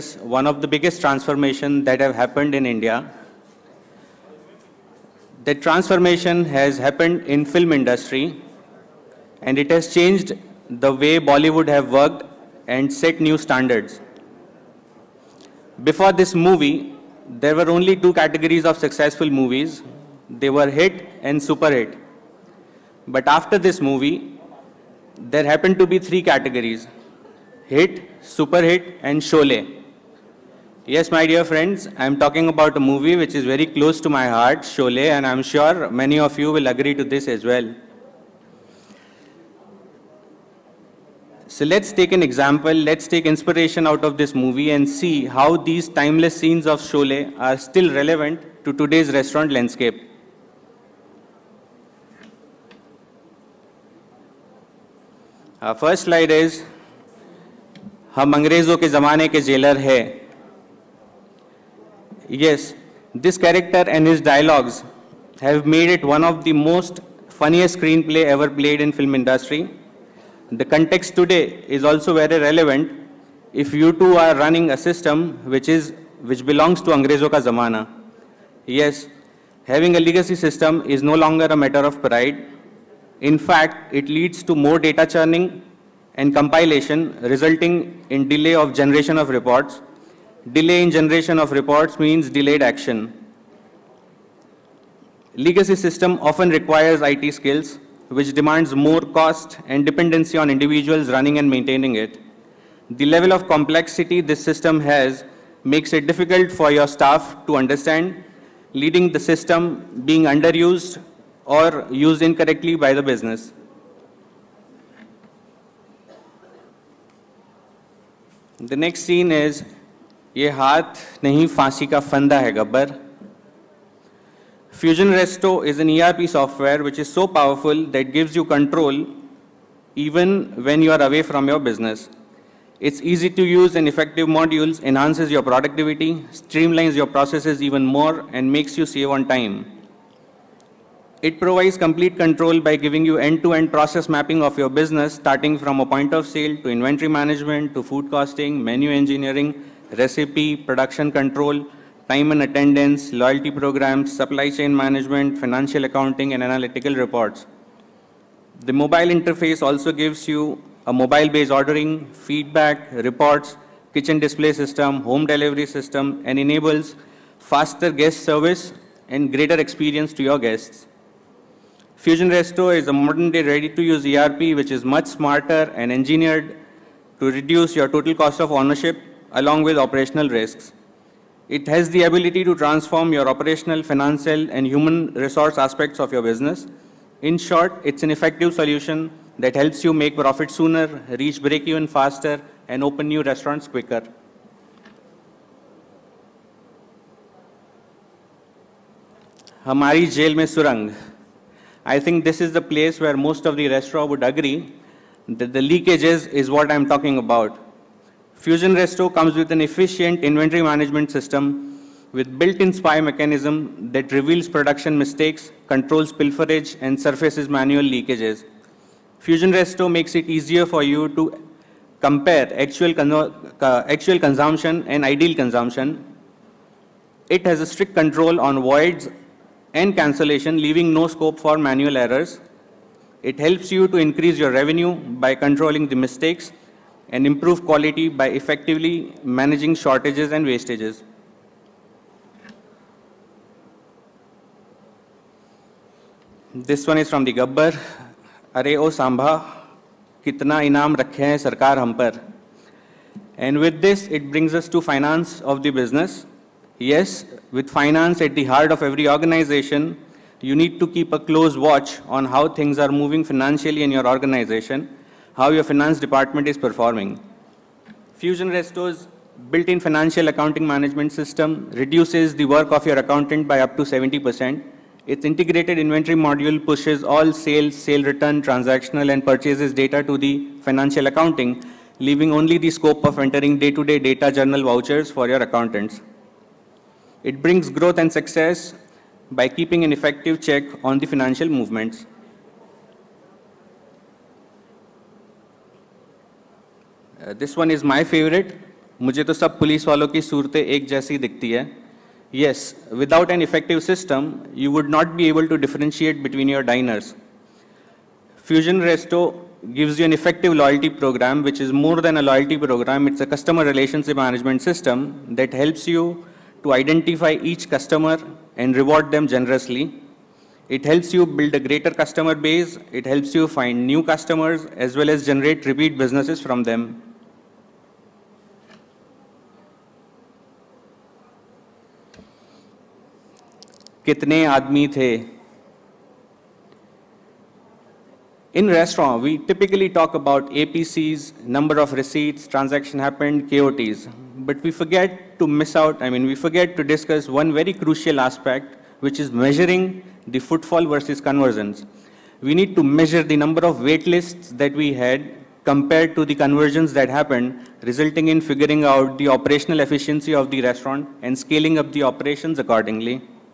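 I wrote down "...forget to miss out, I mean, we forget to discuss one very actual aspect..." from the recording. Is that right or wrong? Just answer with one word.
wrong.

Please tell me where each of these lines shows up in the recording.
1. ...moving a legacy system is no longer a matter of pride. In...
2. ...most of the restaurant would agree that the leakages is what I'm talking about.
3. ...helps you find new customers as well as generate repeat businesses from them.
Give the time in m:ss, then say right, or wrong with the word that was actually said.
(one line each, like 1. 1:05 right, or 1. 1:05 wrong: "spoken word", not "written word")
1. 1:19 wrong: "having", not "moving"
2. 3:23 right
3. 5:23 right.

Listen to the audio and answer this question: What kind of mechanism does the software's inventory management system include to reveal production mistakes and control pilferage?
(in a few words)
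Spy mechanism.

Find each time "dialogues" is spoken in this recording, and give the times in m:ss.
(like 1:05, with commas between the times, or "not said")
1:04.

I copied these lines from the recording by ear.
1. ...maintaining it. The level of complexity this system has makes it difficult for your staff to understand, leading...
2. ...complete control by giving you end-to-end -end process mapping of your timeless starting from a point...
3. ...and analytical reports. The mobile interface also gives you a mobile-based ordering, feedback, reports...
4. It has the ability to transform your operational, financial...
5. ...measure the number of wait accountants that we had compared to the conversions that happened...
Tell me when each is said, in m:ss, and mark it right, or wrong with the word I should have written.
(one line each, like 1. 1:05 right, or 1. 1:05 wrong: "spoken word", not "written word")
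1. 1:41 right
2. 2:21 wrong: "business", not "timeless"
3. 2:36 right
4. 3:01 right
5. 5:52 wrong: "lists", not "accountants".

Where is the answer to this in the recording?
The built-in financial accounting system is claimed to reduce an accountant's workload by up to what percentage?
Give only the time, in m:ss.
4:33.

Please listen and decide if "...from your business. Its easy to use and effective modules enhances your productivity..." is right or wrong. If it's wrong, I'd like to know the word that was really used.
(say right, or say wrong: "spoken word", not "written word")
right.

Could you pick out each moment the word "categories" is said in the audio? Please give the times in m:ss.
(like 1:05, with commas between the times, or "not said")
0:18, 0:26.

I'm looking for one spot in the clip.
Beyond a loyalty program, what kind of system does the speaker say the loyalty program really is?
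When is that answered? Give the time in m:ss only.
5:13.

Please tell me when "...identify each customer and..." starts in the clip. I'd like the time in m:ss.
5:16.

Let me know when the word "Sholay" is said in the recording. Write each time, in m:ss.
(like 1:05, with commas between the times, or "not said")
0:29, 0:34, 0:46.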